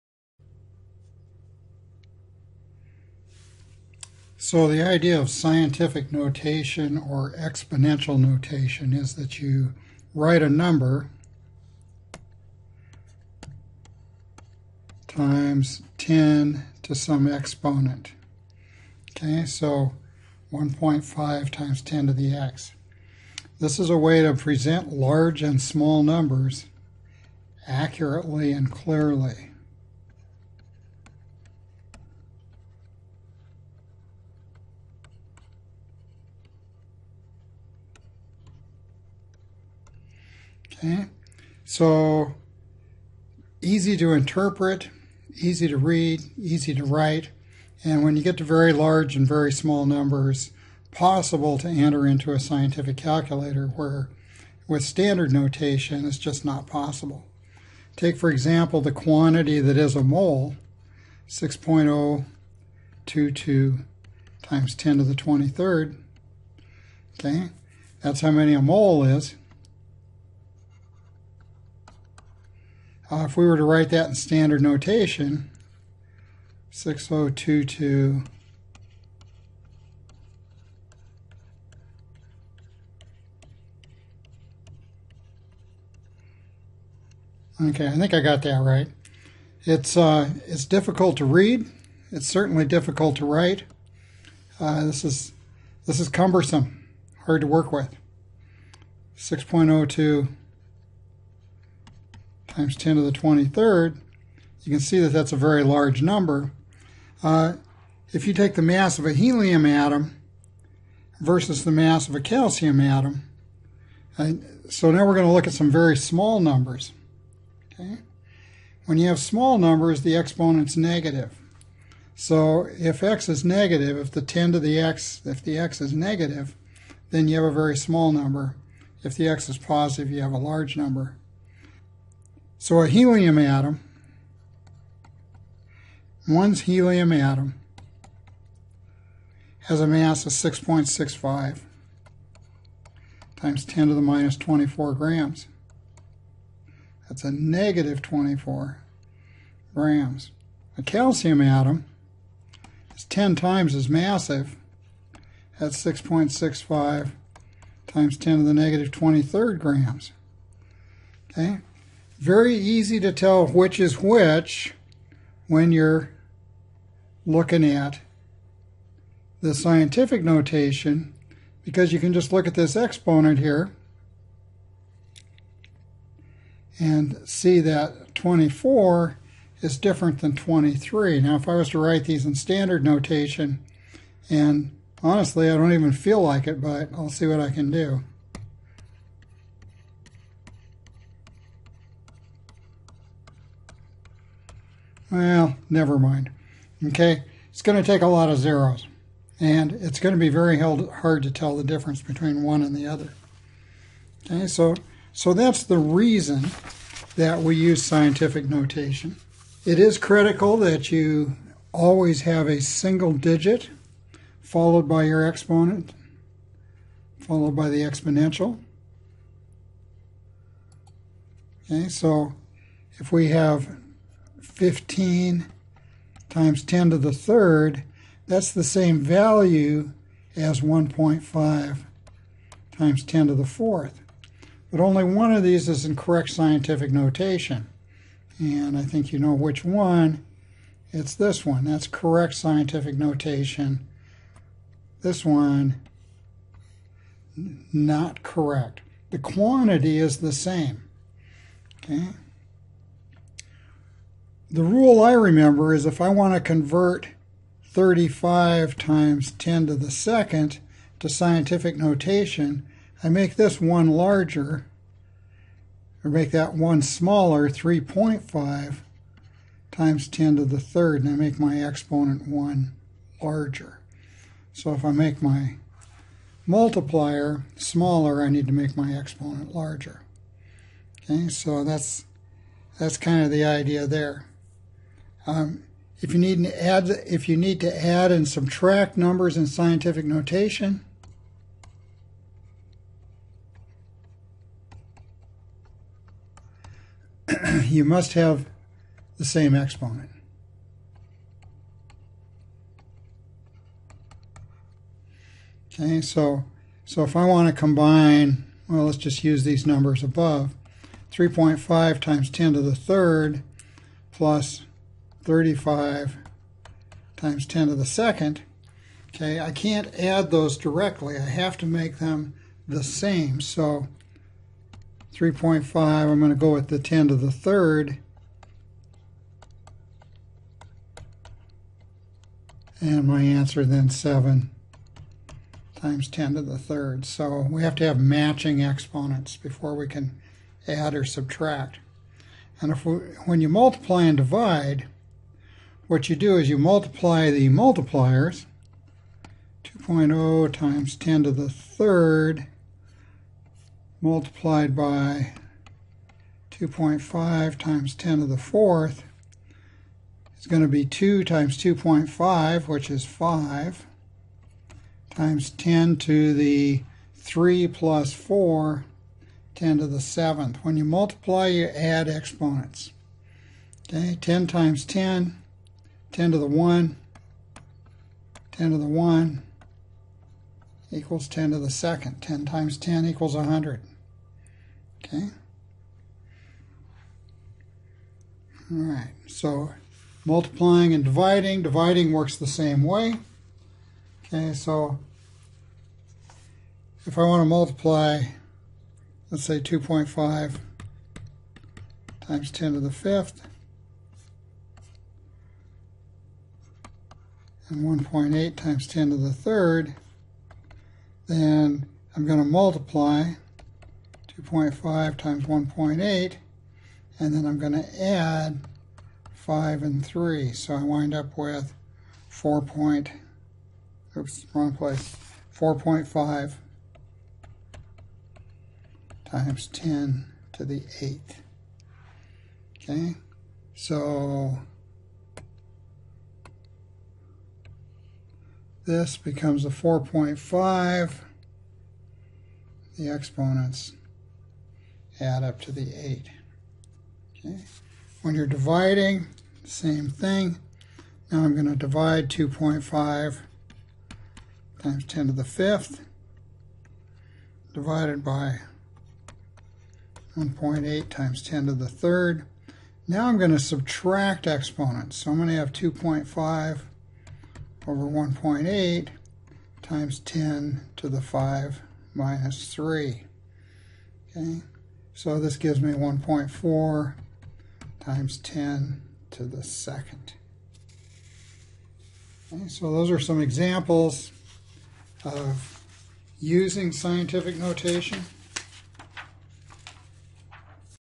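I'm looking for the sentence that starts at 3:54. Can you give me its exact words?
But only one of these is in correct scientific notation.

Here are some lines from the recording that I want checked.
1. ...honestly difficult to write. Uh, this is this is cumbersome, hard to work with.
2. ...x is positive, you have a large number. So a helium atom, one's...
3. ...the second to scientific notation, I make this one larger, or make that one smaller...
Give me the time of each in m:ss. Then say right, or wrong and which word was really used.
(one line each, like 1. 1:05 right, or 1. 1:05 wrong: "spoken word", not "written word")
1. 1:32 wrong: "certainly", not "honestly"
2. 2:09 right
3. 4:19 right.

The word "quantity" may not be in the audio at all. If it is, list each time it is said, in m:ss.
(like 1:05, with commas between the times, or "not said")
0:58, 4:09.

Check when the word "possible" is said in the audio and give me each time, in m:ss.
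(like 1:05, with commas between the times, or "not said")
0:50, 0:56.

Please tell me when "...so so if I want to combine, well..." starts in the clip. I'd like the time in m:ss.
5:06.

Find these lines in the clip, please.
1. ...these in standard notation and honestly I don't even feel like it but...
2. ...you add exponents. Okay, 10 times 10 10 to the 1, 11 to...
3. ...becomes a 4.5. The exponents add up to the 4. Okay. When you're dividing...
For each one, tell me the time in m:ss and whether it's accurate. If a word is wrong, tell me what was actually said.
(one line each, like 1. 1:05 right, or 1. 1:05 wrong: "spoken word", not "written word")
1. 3:02 right
2. 6:11 wrong: "10", not "11"
3. 7:19 wrong: "8", not "4".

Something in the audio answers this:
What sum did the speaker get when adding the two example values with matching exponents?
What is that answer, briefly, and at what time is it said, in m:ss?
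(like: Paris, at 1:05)
7 x 10^3, at 5:33.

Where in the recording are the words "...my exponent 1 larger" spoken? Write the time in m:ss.
4:31.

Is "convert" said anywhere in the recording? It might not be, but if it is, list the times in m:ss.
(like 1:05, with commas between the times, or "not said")
4:16.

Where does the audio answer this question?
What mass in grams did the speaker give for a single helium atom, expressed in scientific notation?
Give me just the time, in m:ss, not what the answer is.
2:20.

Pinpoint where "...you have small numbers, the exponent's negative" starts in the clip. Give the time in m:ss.
1:58.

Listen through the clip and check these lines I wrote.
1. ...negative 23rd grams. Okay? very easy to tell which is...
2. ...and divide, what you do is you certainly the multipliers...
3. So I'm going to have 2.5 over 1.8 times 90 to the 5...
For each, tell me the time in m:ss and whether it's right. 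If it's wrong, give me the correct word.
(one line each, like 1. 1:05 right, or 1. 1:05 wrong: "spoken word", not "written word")
1. 2:38 right
2. 5:44 wrong: "multiply", not "certainly"
3. 7:45 wrong: "10", not "90".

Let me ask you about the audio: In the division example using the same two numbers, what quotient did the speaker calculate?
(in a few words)
1.4 x 10^2.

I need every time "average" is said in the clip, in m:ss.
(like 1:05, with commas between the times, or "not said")
not said.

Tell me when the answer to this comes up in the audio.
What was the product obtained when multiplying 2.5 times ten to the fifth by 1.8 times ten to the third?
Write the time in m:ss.
7:05.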